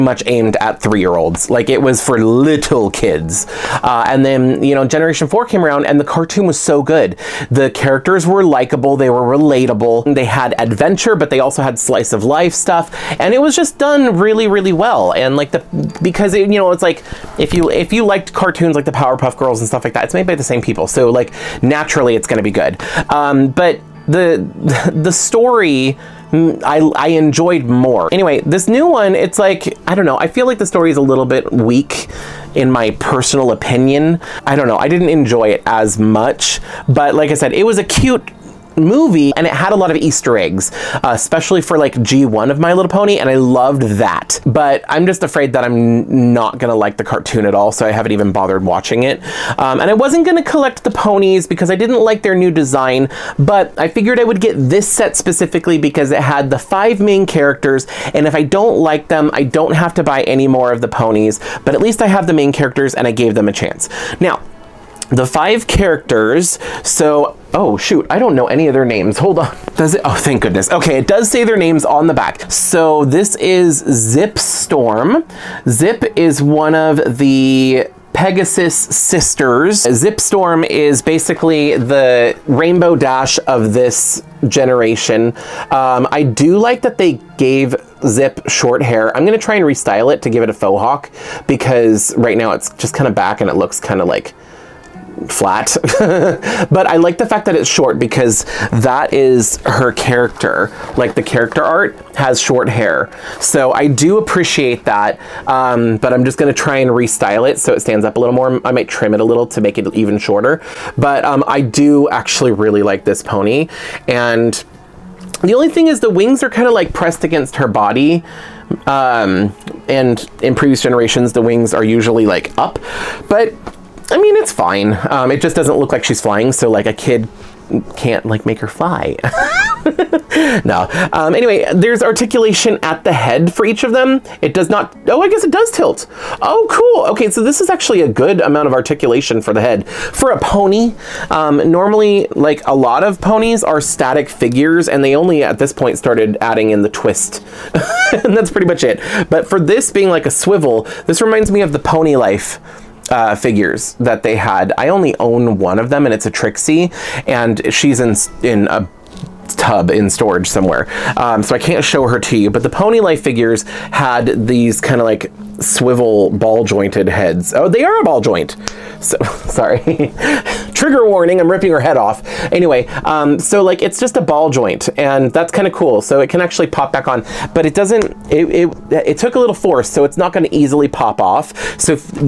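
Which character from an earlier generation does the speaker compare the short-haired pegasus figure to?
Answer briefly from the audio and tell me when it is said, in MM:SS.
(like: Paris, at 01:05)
Rainbow Dash, at 01:22.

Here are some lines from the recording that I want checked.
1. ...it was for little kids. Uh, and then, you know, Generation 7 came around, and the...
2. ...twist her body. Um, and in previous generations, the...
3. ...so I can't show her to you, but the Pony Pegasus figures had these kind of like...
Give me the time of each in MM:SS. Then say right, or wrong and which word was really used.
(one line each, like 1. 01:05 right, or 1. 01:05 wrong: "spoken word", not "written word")
1. 00:01 wrong: "4", not "7"
2. 01:57 wrong: "against", not "twist"
3. 02:41 wrong: "Life", not "Pegasus".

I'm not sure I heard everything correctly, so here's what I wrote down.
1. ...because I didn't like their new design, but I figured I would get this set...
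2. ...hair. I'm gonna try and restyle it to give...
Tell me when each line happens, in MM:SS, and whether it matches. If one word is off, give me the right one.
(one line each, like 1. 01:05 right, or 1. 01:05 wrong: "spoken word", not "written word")
1. 00:51 right
2. 01:28 right.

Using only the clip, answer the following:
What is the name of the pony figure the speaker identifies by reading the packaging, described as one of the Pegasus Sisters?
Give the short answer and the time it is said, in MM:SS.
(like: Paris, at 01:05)
Zip Storm, at 01:13.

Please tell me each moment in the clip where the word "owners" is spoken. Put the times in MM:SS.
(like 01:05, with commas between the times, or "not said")
not said.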